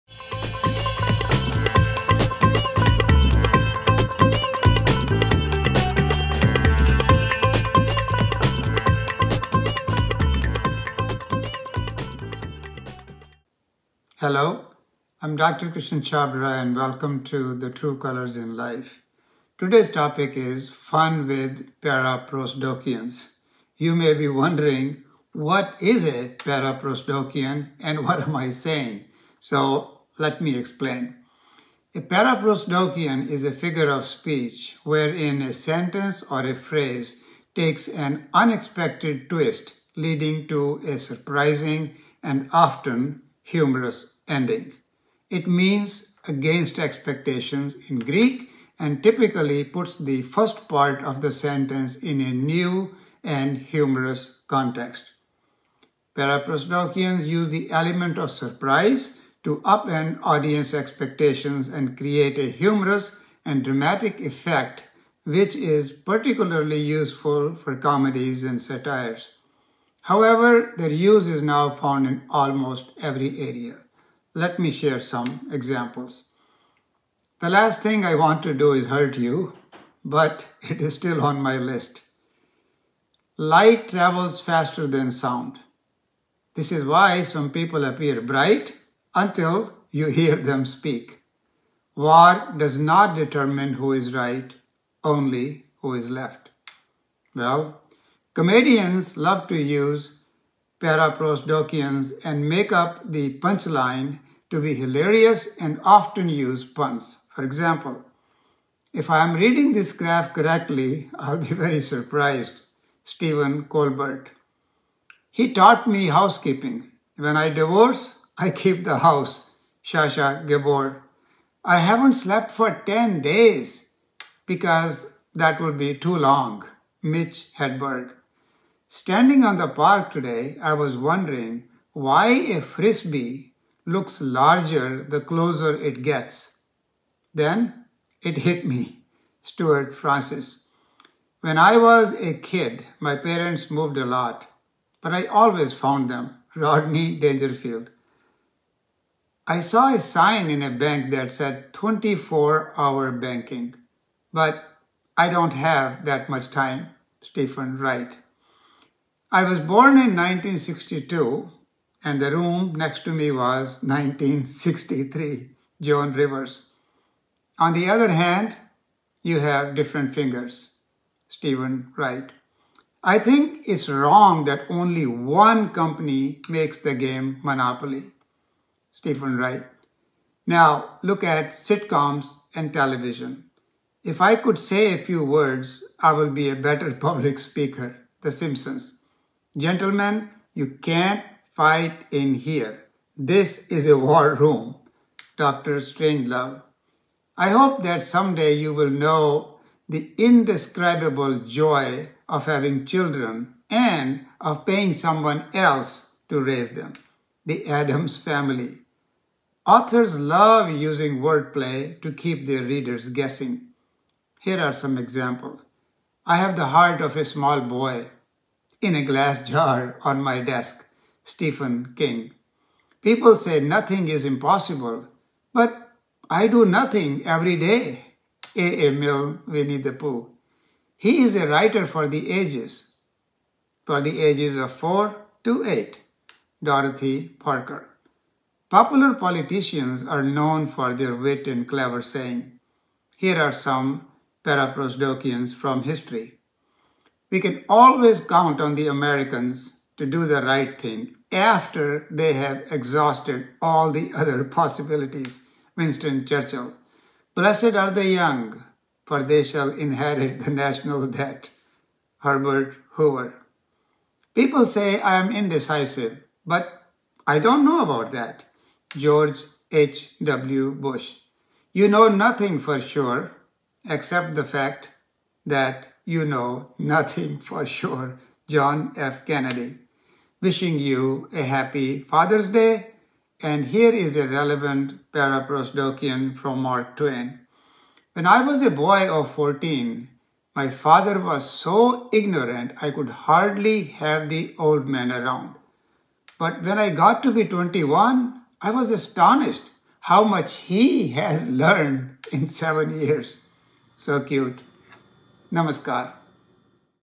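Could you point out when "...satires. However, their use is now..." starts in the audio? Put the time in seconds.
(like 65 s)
68 s.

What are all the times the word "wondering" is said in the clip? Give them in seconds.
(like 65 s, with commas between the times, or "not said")
24 s, 130 s.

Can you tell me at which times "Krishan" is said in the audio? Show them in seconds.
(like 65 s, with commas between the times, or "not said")
15 s.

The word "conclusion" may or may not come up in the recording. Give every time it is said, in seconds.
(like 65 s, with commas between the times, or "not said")
not said.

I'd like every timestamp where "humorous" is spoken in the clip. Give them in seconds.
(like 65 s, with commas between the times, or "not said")
43 s, 53 s, 62 s.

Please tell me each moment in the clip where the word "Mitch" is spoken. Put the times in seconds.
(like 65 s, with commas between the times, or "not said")
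127 s.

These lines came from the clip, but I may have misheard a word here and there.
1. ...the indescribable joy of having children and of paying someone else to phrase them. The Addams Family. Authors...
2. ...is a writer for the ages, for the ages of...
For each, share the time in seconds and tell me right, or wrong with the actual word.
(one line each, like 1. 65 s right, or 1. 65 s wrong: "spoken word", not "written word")
1. 199 s wrong: "raise", not "phrase"
2. 231 s right.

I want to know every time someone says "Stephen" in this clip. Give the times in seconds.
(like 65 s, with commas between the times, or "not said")
113 s, 157 s, 171 s, 178 s, 221 s.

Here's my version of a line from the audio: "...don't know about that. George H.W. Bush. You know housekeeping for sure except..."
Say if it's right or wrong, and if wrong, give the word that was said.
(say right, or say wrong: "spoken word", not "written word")
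wrong: "nothing", not "housekeeping".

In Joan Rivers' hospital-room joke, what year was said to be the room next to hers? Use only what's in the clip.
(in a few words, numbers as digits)
1963.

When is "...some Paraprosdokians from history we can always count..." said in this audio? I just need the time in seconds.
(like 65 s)
243 s.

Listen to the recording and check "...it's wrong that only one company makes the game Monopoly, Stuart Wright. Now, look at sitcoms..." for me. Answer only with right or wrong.
wrong.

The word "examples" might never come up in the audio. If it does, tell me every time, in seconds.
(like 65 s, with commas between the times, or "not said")
75 s, 107 s, 214 s.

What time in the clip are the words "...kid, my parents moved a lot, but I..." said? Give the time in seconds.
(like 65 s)
142 s.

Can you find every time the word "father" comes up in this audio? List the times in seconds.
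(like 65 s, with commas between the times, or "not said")
281 s, 290 s.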